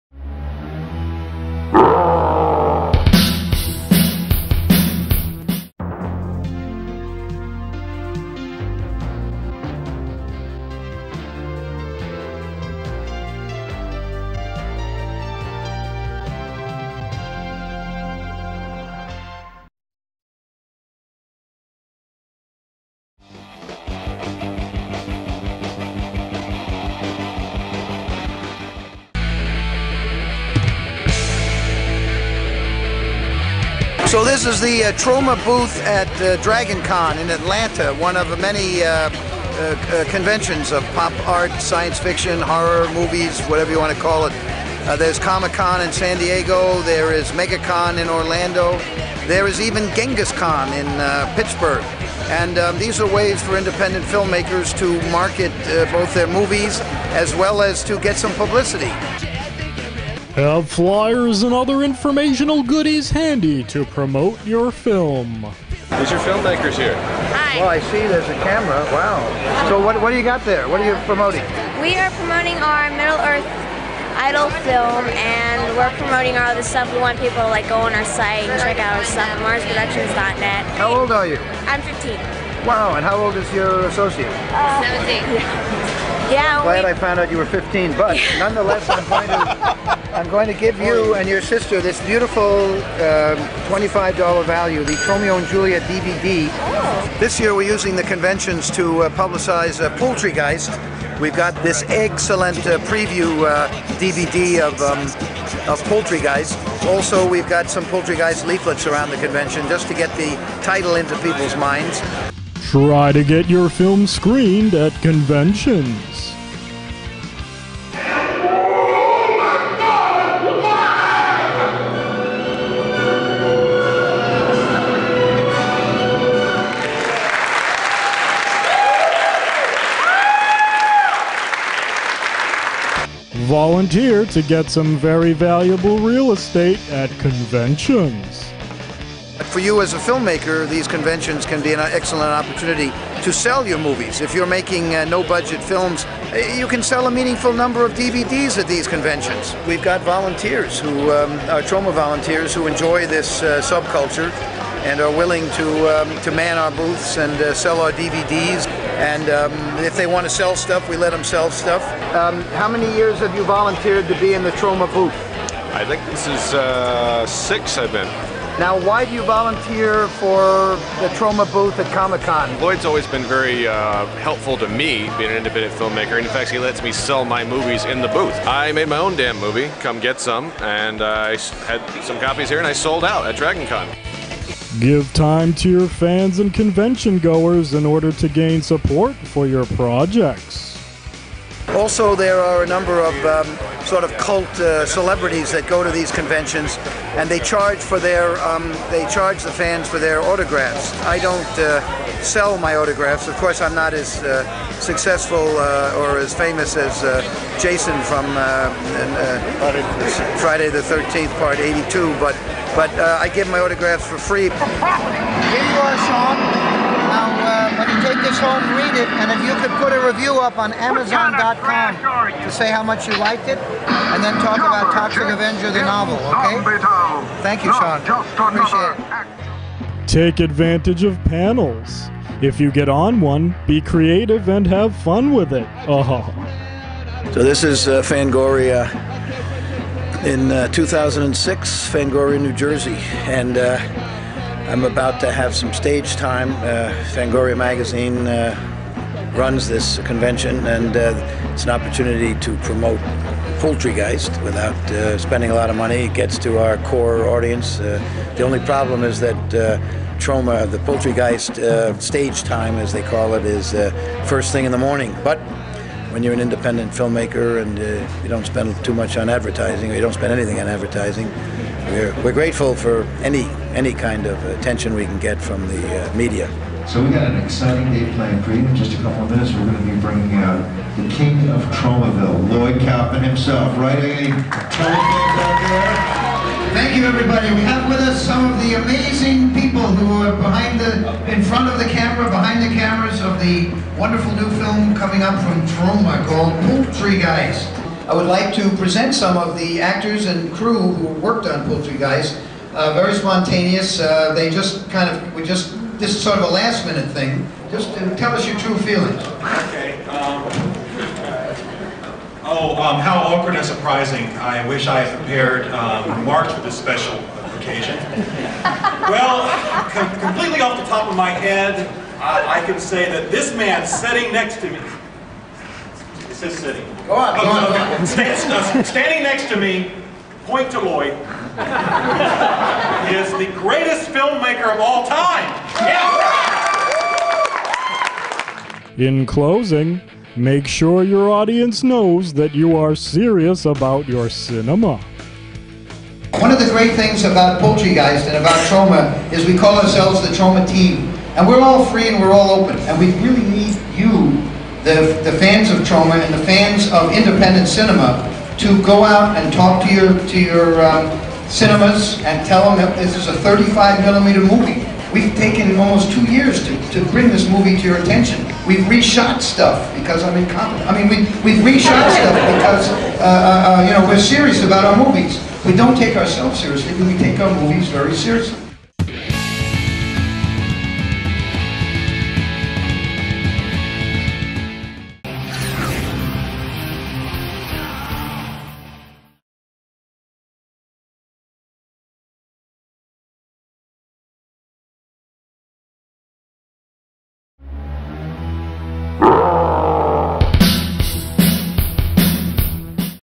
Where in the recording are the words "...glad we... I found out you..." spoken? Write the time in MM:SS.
01:26.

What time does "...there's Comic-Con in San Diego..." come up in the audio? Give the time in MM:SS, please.
00:44.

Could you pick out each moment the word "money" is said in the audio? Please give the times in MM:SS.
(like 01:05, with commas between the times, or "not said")
04:15.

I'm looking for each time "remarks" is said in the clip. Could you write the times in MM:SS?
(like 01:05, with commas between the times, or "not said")
05:16.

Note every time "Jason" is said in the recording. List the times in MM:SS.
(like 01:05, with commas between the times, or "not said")
03:27.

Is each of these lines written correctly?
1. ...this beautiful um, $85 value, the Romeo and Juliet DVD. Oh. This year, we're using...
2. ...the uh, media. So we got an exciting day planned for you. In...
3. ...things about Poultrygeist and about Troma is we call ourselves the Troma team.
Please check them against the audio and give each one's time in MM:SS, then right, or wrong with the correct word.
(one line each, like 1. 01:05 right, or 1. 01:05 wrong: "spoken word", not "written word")
1. 01:31 wrong: "25", not "85"
2. 04:35 right
3. 05:46 right.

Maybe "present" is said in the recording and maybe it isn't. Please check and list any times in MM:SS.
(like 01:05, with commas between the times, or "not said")
04:58.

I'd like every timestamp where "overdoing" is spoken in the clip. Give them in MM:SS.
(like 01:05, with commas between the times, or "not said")
not said.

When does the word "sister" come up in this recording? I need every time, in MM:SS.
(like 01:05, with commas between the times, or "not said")
01:31.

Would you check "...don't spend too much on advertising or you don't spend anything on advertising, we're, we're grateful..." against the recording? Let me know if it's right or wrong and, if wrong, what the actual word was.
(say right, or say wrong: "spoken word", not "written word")
right.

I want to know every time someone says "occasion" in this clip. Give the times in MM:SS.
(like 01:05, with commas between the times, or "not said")
05:17.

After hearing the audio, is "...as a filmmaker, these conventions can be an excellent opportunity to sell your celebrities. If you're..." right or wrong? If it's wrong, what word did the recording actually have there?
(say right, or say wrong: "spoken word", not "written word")
wrong: "movies", not "celebrities".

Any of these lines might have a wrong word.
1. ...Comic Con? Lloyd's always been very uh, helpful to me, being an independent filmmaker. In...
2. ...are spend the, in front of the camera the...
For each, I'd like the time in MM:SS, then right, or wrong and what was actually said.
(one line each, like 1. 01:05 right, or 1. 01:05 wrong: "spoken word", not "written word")
1. 02:51 right
2. 04:50 wrong: "behind", not "spend".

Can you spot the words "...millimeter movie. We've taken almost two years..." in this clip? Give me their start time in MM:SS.
06:04.